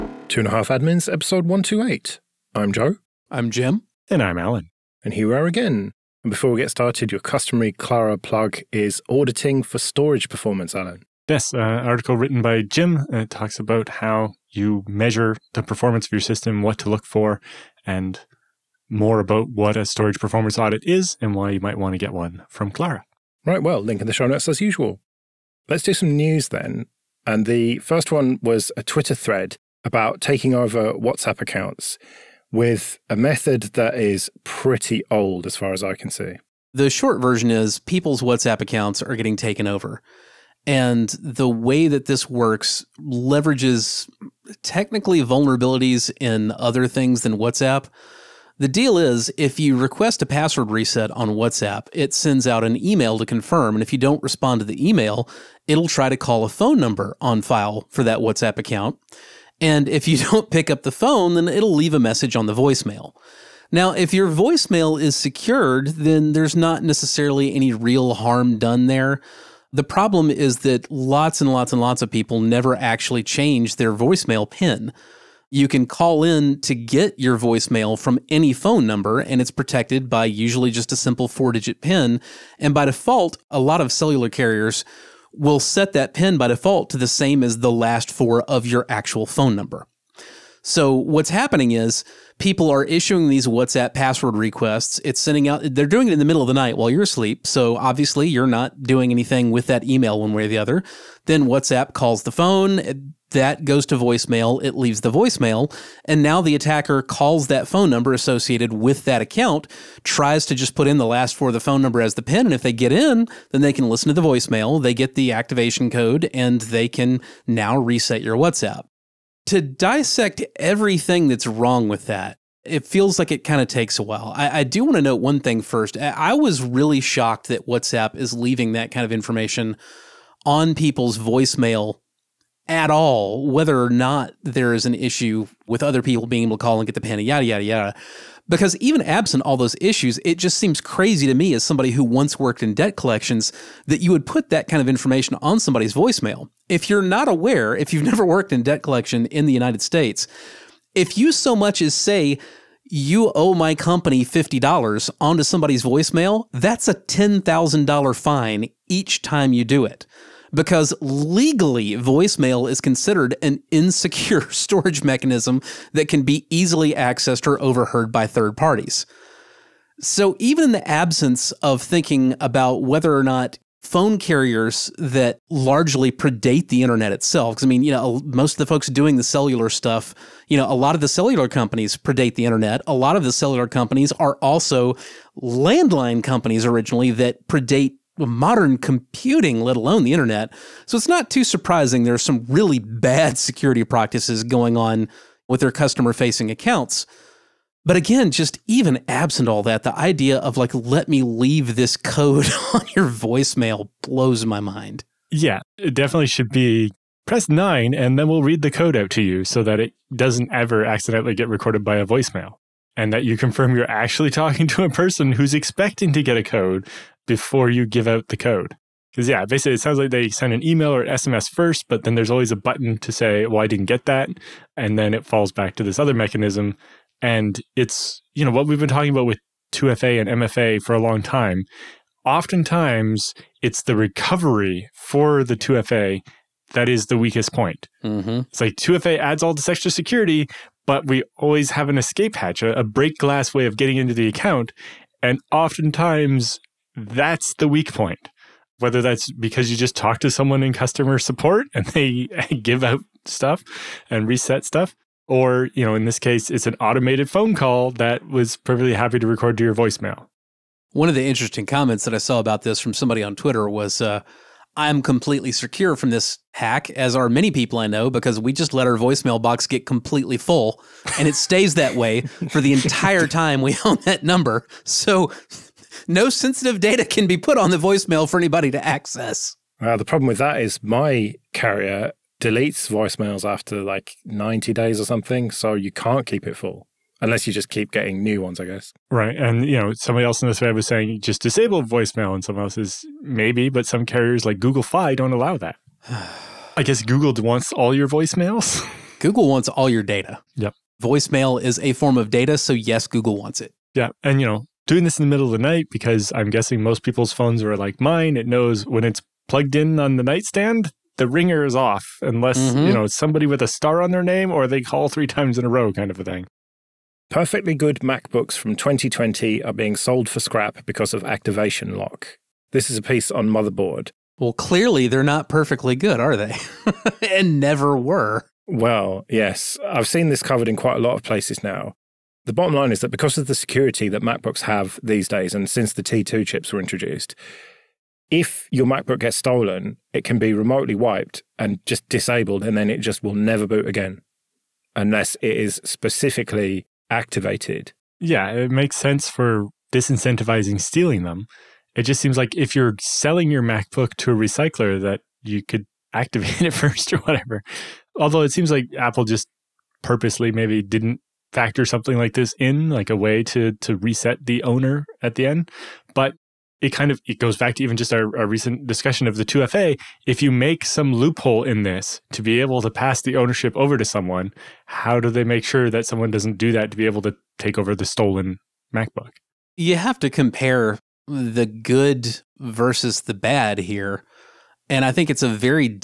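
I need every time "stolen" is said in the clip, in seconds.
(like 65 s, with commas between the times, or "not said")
339 s, 378 s.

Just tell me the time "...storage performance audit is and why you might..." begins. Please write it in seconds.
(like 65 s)
19 s.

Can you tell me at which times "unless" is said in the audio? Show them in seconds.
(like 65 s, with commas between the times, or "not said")
287 s, 312 s, 344 s.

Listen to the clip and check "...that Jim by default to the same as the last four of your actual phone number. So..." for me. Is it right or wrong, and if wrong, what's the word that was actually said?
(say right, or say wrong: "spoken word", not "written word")
wrong: "PIN", not "Jim".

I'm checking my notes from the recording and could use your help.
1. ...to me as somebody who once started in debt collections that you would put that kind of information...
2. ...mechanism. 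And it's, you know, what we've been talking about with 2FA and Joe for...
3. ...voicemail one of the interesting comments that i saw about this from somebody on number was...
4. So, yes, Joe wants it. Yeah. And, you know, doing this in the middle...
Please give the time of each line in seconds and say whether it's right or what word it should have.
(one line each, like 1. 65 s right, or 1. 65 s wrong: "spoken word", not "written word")
1. 141 s wrong: "worked", not "started"
2. 226 s wrong: "MFA", not "Joe"
3. 259 s wrong: "twitter", not "number"
4. 302 s wrong: "Google", not "Joe".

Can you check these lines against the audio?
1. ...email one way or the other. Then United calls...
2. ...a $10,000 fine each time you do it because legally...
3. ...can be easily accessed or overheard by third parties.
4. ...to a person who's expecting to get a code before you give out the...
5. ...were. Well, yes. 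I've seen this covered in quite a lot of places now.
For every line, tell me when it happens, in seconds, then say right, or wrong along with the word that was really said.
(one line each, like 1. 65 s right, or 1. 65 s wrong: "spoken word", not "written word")
1. 99 s wrong: "WhatsApp", not "United"
2. 156 s right
3. 166 s right
4. 214 s right
5. 327 s right.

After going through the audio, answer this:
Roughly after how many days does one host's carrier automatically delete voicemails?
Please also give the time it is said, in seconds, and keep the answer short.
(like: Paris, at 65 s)
90 days, at 284 s.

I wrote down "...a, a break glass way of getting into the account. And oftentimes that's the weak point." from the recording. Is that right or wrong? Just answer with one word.
right.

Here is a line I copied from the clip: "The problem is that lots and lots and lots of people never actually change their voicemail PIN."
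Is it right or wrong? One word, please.
right.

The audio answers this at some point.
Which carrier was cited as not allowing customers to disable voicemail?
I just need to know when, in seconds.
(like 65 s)
294 s.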